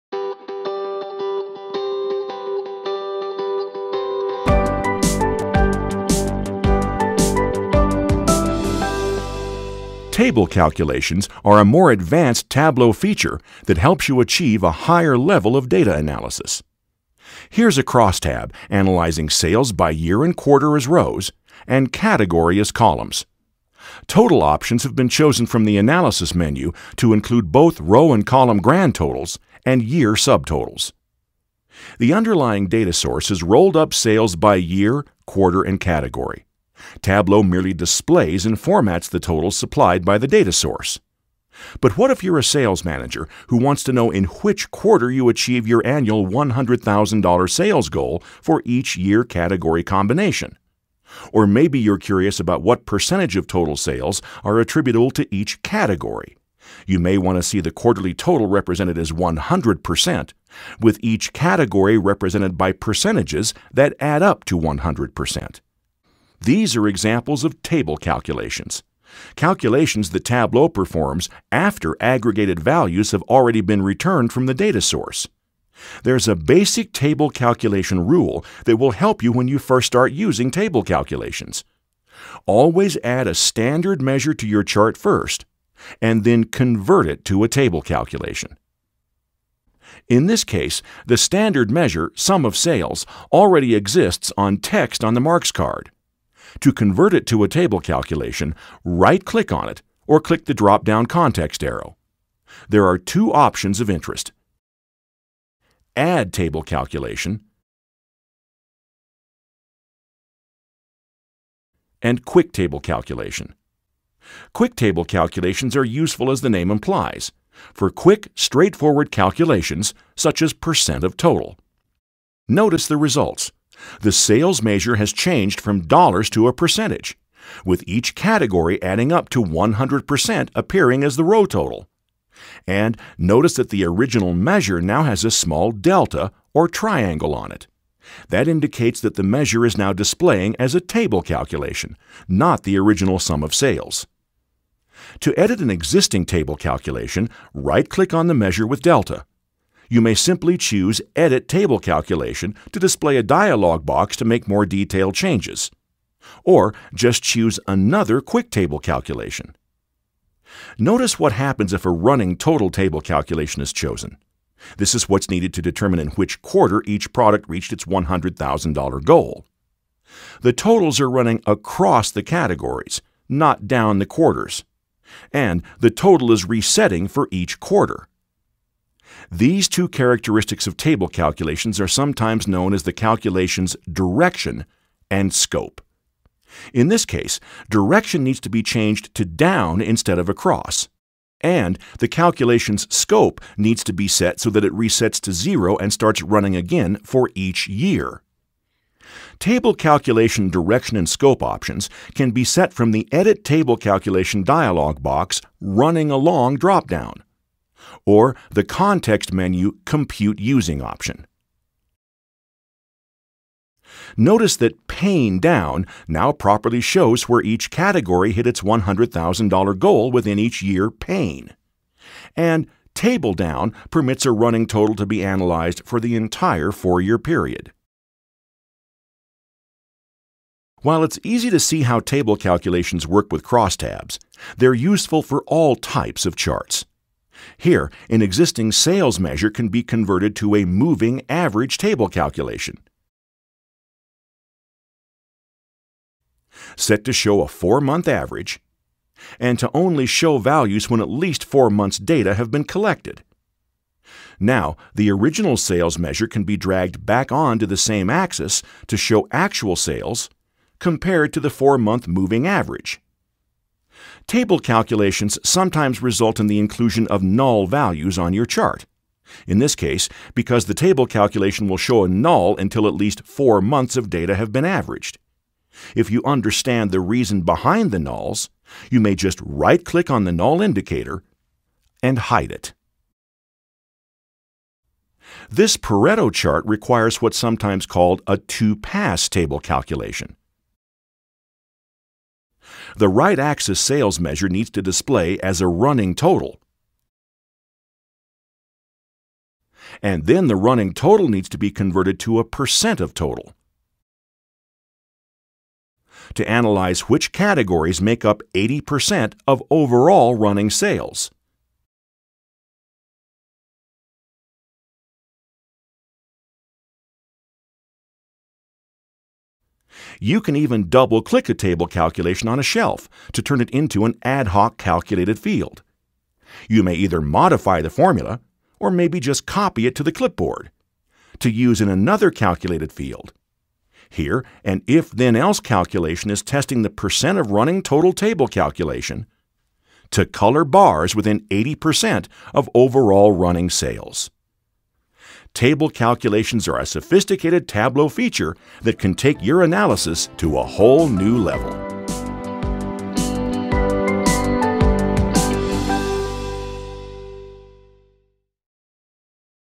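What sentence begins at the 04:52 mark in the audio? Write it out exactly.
The right axis sales measure needs to display as a running total.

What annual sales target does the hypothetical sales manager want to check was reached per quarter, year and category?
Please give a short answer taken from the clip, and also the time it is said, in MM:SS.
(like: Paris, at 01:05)
$100,000, at 00:46.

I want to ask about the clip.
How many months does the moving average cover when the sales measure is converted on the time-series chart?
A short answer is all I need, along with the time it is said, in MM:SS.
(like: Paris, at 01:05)
4, at 04:07.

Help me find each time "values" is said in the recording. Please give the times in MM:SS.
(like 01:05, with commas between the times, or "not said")
01:12, 04:10, 04:27.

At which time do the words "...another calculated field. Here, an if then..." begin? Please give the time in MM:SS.
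05:31.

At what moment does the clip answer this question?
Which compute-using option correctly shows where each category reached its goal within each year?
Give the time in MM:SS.
03:34.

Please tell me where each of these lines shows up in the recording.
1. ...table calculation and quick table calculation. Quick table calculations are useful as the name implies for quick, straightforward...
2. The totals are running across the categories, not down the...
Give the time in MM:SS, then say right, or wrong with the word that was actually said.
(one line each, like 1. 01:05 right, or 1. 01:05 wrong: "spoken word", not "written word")
1. 01:46 right
2. 02:50 right.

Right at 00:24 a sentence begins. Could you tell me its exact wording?
Total options have been chosen from the analysis menu to include both row and column grand totals and year subtotals.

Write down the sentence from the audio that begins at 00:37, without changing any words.
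Tableau merely displays and formats the totals supplied by the data source.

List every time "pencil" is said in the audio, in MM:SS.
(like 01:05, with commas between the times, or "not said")
not said.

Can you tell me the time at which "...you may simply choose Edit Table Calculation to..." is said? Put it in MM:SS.
02:29.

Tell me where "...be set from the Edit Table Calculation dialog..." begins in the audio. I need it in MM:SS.
03:22.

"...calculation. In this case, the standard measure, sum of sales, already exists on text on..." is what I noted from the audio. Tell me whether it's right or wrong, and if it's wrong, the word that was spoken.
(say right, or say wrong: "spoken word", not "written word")
right.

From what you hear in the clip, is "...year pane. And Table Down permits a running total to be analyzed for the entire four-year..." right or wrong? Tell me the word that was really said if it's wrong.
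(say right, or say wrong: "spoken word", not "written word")
right.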